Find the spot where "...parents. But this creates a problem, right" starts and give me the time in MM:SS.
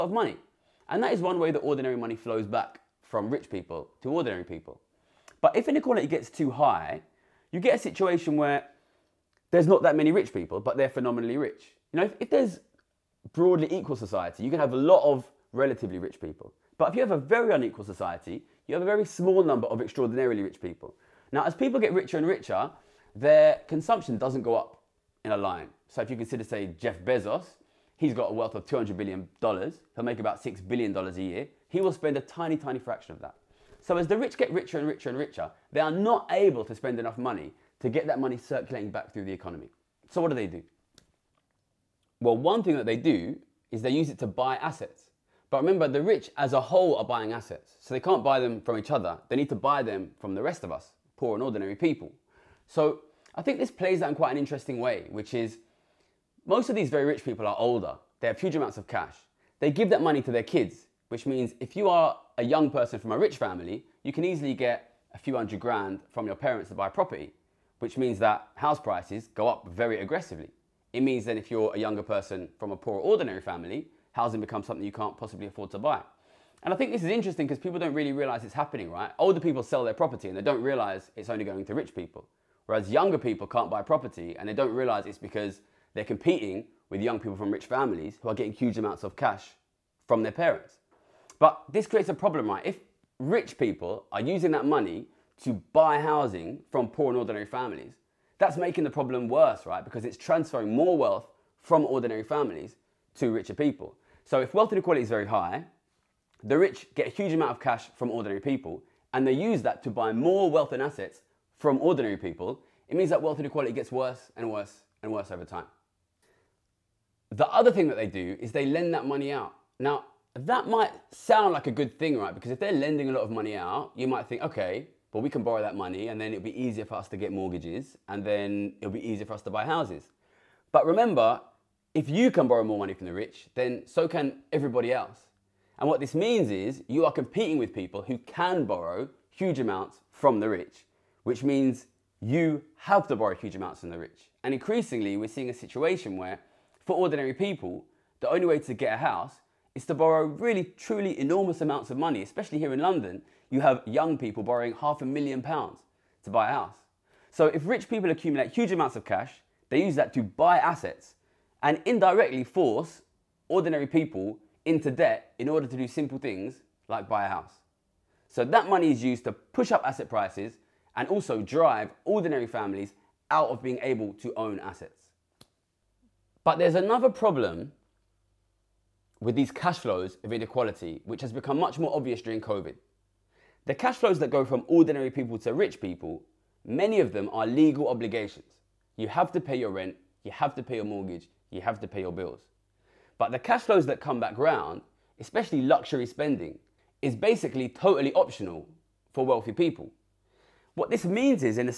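01:30.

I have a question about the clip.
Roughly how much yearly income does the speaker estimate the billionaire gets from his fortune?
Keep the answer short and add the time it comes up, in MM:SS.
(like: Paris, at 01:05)
$6 billion, at 00:30.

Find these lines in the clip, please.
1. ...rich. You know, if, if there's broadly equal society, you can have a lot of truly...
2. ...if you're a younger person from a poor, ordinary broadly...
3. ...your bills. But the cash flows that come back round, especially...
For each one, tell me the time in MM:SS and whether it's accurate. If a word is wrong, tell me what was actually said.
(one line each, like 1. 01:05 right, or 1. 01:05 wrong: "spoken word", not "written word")
1. 00:11 wrong: "relatively", not "truly"
2. 01:11 wrong: "family", not "broadly"
3. 03:11 right.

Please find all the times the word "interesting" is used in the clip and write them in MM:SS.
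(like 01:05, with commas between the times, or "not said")
00:54, 01:17.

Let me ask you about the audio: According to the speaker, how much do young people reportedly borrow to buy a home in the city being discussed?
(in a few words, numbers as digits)
half a million pounds.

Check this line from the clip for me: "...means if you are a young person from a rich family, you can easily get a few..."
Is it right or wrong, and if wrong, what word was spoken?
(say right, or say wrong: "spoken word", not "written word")
right.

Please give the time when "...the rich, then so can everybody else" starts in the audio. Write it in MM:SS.
02:13.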